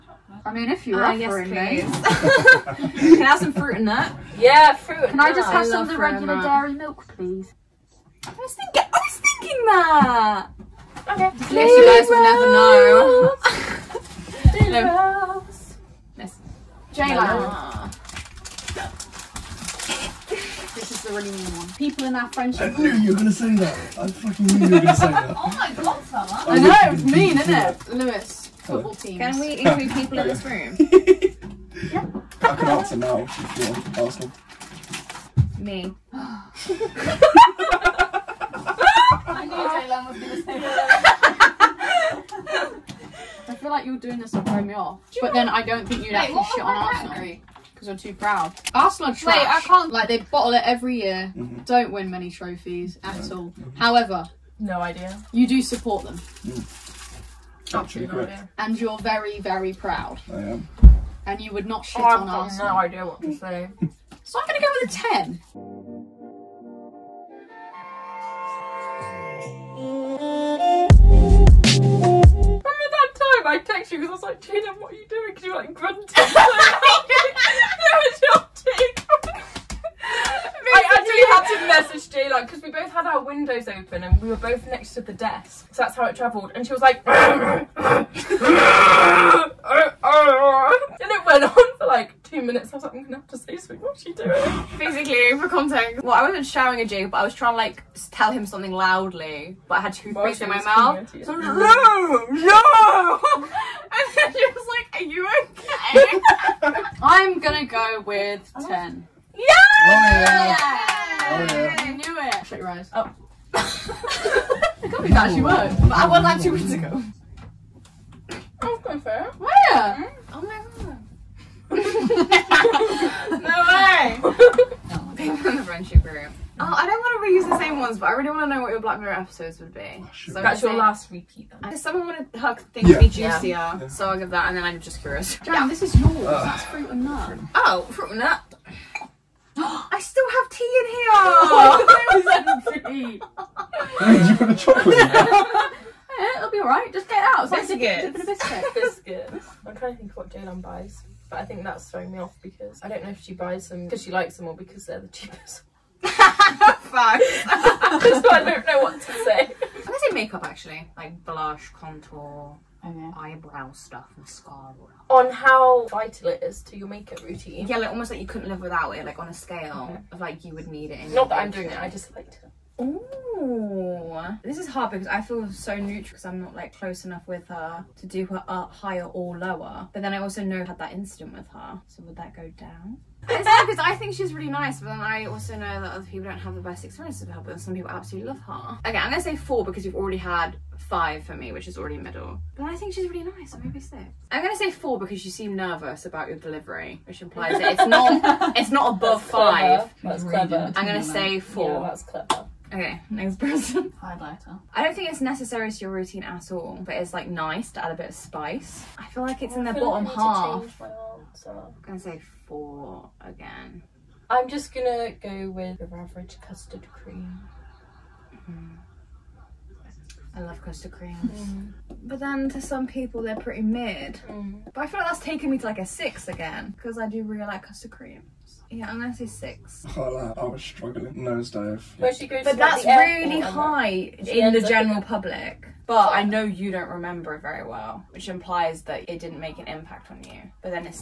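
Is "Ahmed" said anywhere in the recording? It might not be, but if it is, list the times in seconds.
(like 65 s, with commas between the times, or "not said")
not said.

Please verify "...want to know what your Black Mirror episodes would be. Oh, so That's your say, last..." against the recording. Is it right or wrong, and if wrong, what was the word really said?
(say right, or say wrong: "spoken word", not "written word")
right.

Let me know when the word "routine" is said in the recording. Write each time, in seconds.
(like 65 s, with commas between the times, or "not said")
167 s, 205 s.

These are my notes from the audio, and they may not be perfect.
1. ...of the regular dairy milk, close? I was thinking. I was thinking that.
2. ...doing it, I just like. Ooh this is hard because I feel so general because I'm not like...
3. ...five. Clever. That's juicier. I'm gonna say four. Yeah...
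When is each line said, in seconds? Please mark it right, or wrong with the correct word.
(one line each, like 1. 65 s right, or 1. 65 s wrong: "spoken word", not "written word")
1. 5 s wrong: "please", not "close"
2. 171 s wrong: "neutral", not "general"
3. 199 s wrong: "clever", not "juicier".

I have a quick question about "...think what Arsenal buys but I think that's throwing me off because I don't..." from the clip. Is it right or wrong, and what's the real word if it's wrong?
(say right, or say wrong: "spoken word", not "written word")
wrong: "Jaylan", not "Arsenal".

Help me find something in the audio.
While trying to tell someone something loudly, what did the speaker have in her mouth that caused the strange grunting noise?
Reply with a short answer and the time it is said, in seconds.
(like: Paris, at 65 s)
toothpaste, at 99 s.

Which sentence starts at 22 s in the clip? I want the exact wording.
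I knew you were going to say that.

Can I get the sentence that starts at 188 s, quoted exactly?
Okay, I'm gonna say four because you have already had five for me, which is already middle.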